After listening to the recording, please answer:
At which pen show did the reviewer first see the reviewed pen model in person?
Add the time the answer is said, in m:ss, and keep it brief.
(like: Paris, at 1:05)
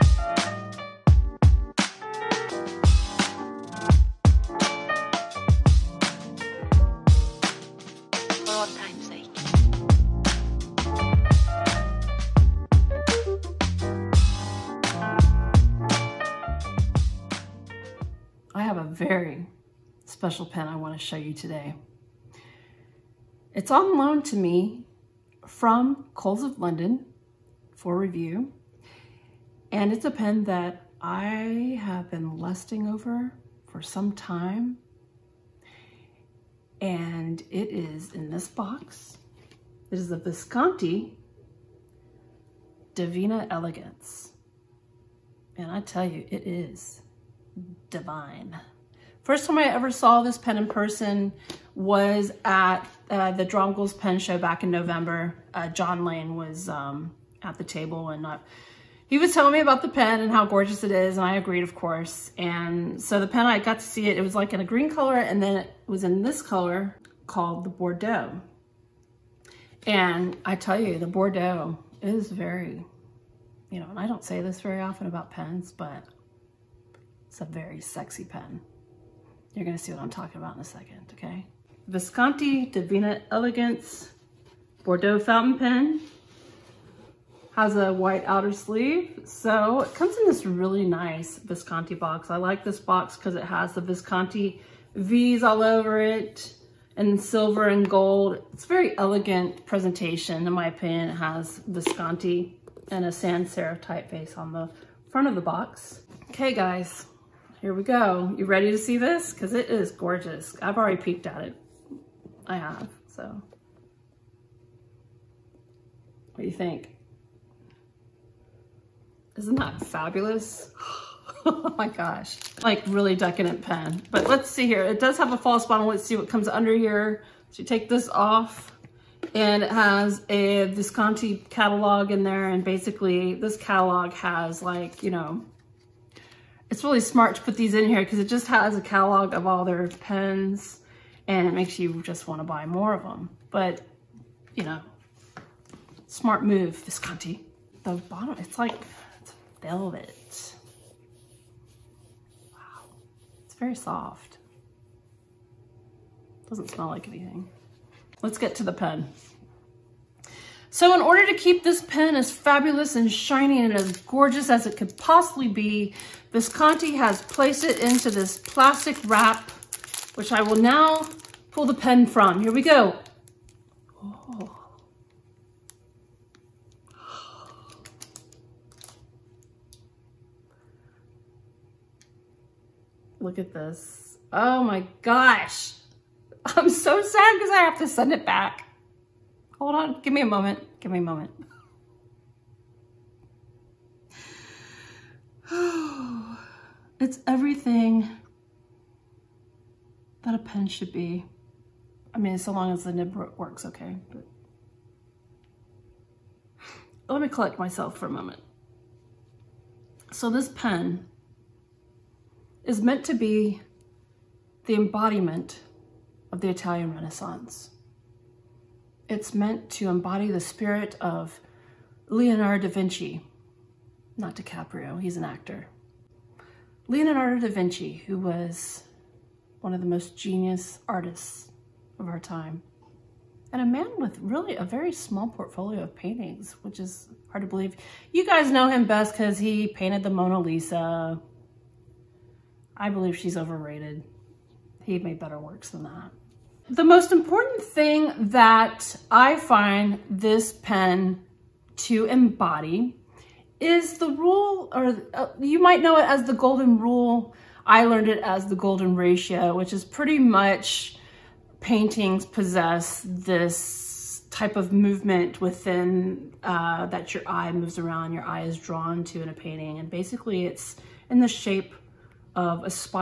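Drongles Pen Show, at 0:53.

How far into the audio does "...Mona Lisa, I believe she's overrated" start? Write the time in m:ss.
4:00.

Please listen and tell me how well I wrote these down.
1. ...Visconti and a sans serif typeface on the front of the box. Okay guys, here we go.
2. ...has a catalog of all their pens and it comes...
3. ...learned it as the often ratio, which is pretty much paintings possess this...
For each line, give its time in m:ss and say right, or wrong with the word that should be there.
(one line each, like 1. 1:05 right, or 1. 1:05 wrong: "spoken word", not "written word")
1. 1:41 right
2. 2:18 wrong: "makes", not "comes"
3. 4:17 wrong: "golden", not "often".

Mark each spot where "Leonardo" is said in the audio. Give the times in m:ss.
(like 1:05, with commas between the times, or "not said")
3:42, 3:46.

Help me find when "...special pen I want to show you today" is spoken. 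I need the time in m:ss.
0:20.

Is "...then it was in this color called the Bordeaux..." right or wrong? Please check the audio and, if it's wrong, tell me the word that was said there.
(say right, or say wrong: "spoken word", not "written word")
right.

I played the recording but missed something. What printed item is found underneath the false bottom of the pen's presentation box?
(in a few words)
Visconti catalog.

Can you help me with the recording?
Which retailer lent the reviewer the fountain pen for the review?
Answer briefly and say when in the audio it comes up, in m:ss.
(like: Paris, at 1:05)
Coles of London, at 0:26.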